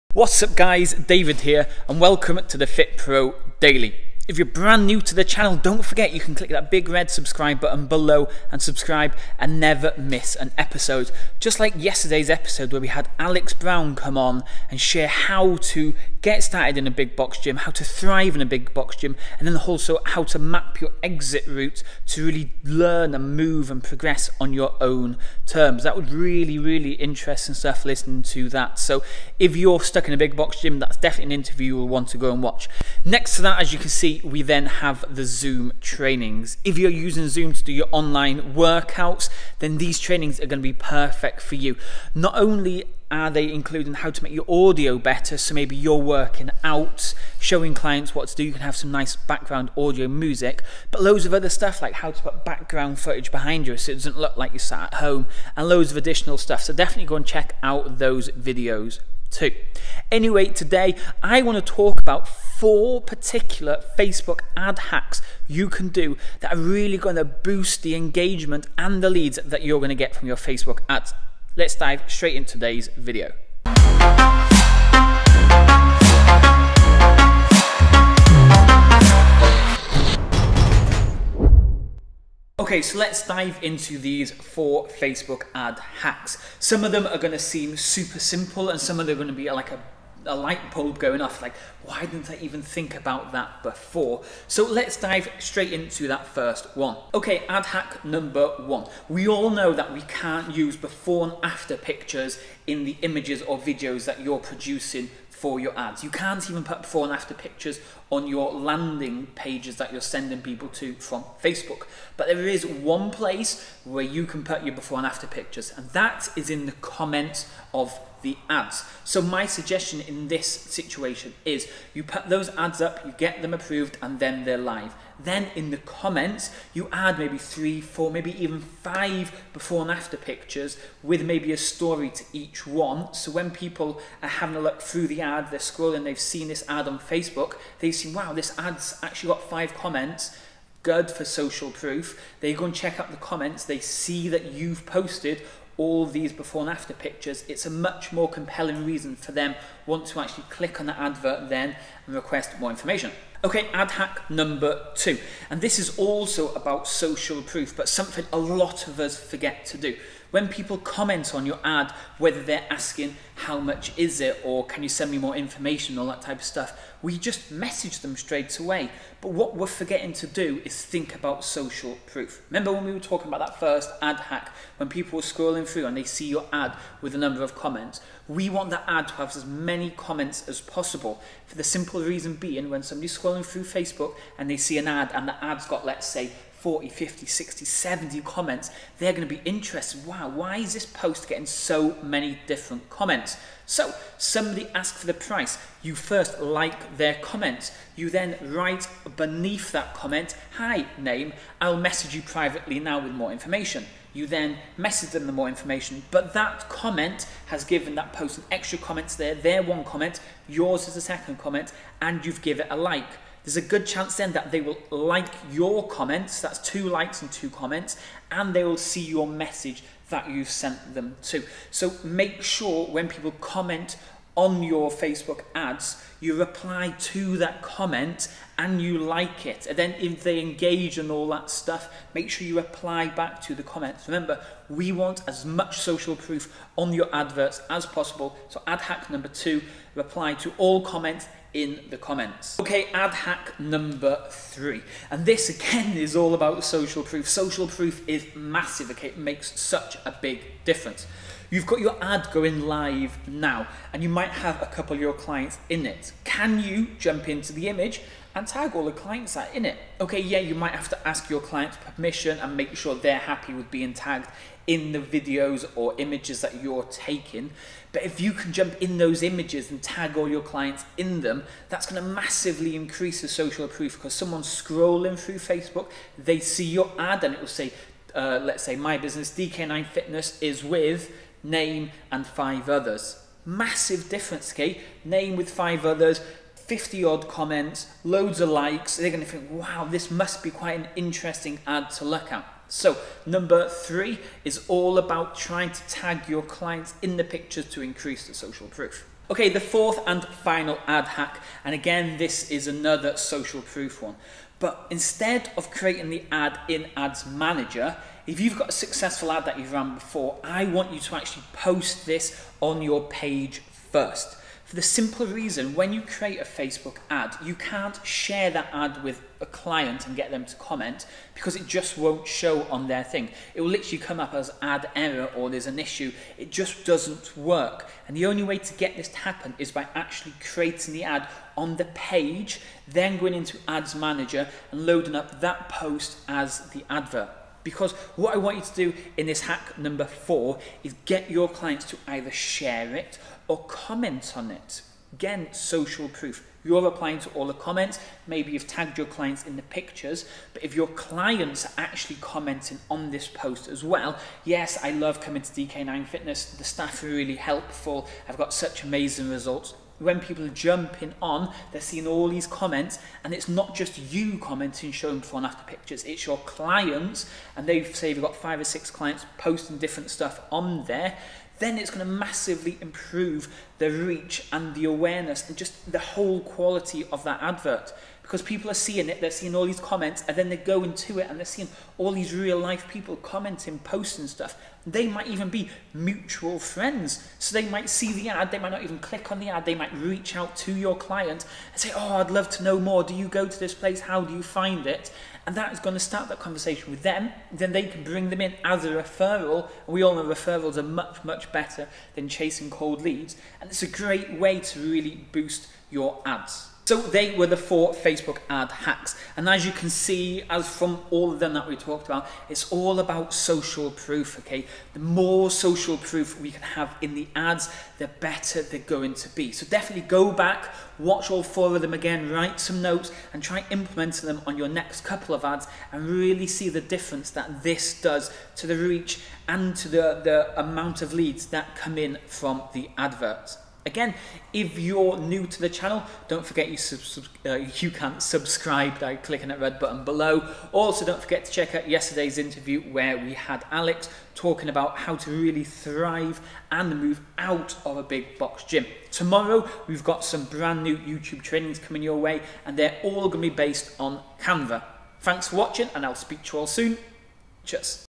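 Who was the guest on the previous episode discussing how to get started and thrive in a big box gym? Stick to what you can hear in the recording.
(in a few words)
Alex Brown.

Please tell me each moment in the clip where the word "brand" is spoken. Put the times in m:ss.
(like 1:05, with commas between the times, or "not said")
0:04, 7:30.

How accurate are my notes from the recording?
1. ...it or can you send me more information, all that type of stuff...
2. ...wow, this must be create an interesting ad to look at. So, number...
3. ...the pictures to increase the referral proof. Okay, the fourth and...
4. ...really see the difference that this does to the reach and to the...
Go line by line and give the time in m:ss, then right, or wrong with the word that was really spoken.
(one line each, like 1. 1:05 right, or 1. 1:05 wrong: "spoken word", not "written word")
1. 2:44 right
2. 4:49 wrong: "quite", not "create"
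3. 4:57 wrong: "social", not "referral"
4. 7:06 right.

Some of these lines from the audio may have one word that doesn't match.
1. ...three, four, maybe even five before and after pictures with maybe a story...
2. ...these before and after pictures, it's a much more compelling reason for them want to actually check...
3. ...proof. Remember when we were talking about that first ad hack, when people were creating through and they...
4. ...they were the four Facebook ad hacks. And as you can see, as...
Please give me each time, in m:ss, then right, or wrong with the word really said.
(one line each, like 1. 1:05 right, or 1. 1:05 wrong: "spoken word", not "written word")
1. 2:07 right
2. 2:26 wrong: "click", not "check"
3. 2:52 wrong: "scrolling", not "creating"
4. 6:47 right.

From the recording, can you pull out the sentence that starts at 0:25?
That was really, really interesting stuff listening to that.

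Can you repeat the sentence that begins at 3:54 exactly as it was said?
Remember, we want as much social proof on your adverts as possible.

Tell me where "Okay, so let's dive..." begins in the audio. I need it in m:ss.
1:22.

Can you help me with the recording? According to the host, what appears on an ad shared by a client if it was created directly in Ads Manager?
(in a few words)
Ad error.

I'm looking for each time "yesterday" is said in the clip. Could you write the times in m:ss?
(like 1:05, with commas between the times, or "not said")
0:11, 7:21.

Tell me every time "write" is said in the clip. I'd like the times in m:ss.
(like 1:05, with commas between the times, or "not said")
3:18, 7:02.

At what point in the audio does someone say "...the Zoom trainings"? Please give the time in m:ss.
0:35.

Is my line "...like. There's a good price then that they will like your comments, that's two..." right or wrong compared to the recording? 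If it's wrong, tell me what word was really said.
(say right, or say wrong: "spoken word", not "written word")
wrong: "chance", not "price".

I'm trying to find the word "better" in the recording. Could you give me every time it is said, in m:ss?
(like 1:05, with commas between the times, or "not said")
0:44, 6:41, 6:58.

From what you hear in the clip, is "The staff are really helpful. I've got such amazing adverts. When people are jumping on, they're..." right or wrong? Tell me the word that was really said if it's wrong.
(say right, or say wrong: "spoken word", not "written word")
wrong: "results", not "adverts".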